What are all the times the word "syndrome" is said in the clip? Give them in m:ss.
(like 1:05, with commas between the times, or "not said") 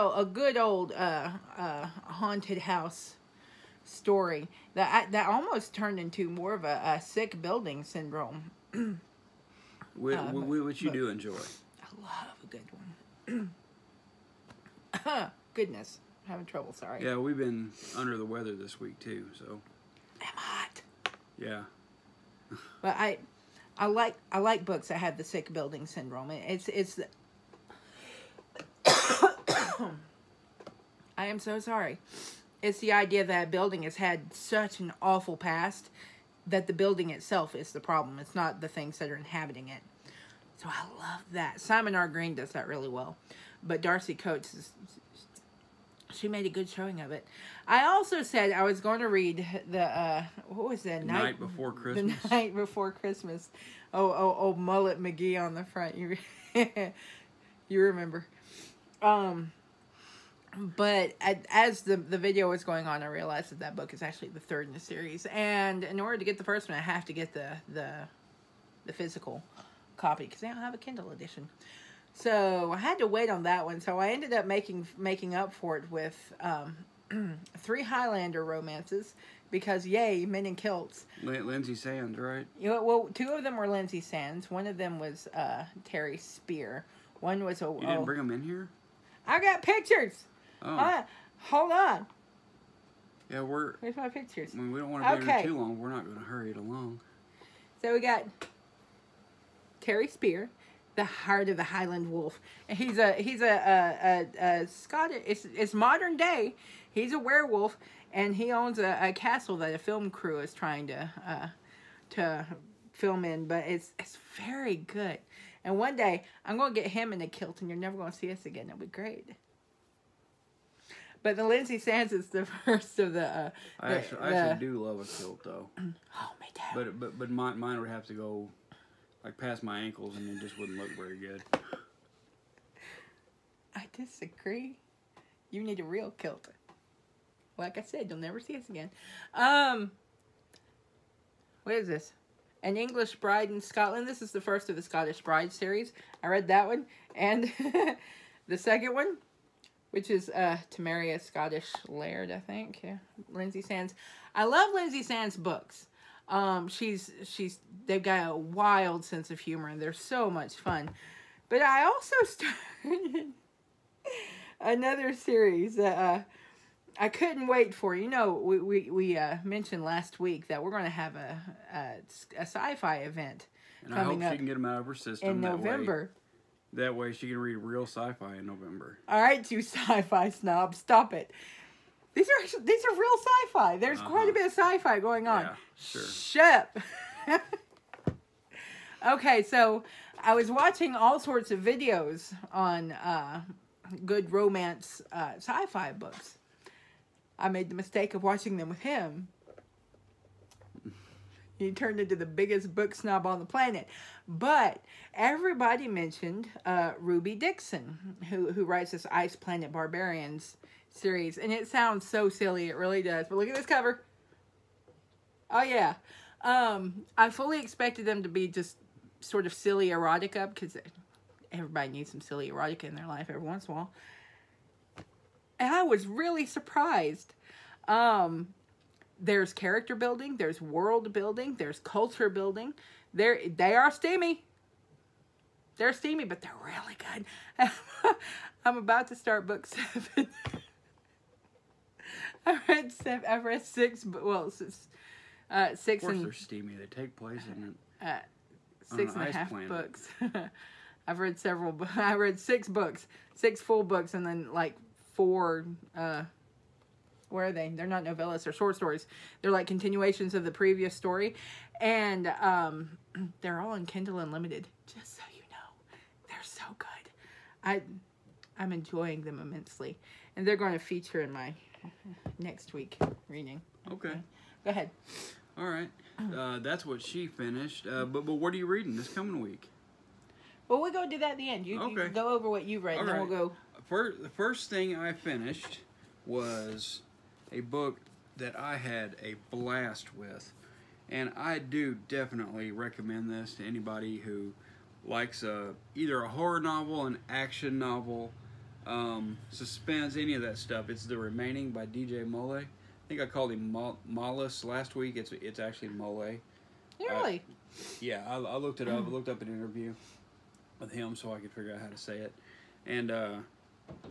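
0:07, 0:25.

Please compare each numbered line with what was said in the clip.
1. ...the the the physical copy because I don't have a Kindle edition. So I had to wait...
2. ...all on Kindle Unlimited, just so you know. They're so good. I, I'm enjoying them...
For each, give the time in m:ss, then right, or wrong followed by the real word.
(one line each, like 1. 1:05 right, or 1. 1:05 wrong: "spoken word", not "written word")
1. 1:07 right
2. 4:23 right.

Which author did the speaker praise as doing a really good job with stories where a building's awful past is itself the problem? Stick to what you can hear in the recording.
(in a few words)
Simon R. Green.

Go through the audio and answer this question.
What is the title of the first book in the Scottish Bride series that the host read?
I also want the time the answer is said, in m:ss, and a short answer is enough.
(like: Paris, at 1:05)
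An English Bride in Scotland, at 2:22.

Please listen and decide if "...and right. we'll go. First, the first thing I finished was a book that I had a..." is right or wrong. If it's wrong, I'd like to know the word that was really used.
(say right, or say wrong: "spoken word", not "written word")
right.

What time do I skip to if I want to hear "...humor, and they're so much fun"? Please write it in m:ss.
2:39.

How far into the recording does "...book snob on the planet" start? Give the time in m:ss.
3:22.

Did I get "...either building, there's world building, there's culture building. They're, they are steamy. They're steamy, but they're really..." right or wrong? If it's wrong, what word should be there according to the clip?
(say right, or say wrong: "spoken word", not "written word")
wrong: "character", not "either".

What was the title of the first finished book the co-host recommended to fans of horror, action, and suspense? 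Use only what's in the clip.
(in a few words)
The Remaining.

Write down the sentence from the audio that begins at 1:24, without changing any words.
One of them was uh, Terry Spear.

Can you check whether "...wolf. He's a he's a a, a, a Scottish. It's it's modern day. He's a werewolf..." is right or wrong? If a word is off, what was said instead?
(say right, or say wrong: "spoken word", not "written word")
right.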